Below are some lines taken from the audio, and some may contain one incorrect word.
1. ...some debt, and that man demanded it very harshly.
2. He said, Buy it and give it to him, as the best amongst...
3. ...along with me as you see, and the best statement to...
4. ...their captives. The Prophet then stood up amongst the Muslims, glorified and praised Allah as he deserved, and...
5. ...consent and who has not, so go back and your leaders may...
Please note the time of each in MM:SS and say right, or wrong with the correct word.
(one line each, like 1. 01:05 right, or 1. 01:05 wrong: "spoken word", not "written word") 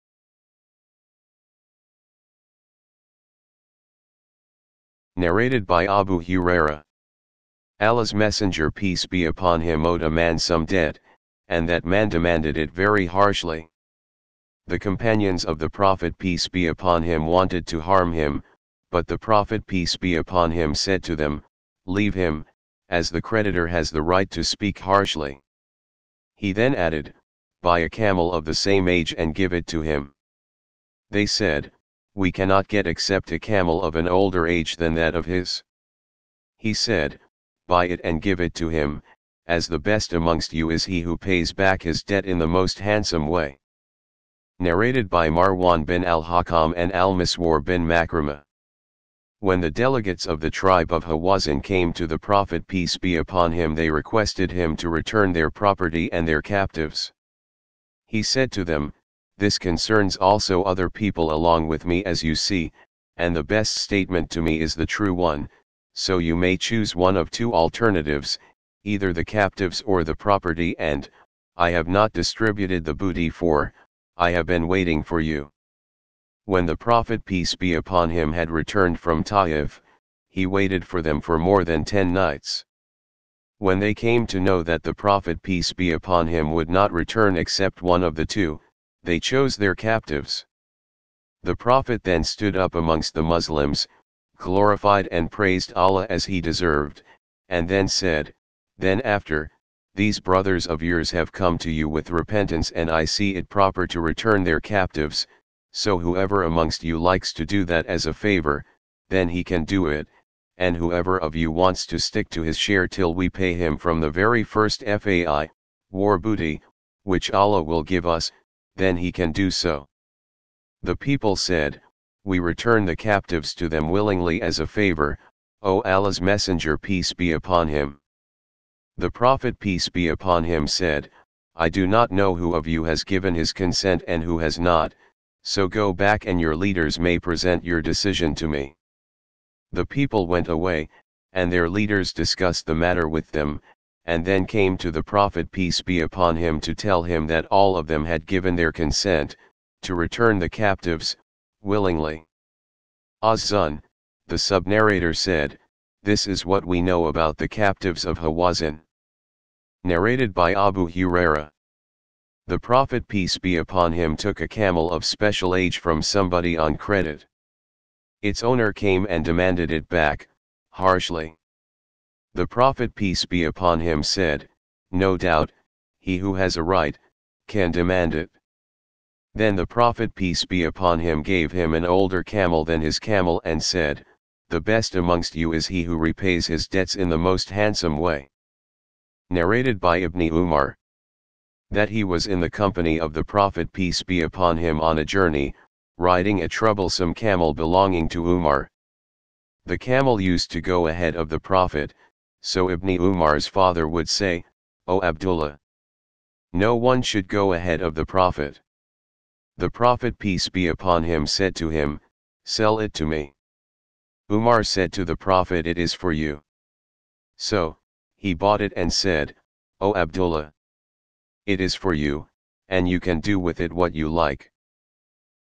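1. 00:10 right
2. 00:36 right
3. 01:01 right
4. 01:29 right
5. 02:13 right.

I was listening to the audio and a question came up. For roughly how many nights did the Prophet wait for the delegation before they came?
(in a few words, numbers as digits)
more than 10.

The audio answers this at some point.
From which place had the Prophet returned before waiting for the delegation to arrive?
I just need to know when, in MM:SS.
01:19.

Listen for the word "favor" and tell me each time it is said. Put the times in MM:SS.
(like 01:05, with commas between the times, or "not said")
01:48, 02:04.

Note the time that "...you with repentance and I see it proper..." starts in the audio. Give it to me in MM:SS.
01:41.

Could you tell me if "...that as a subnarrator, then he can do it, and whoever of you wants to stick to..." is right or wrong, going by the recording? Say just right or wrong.
wrong.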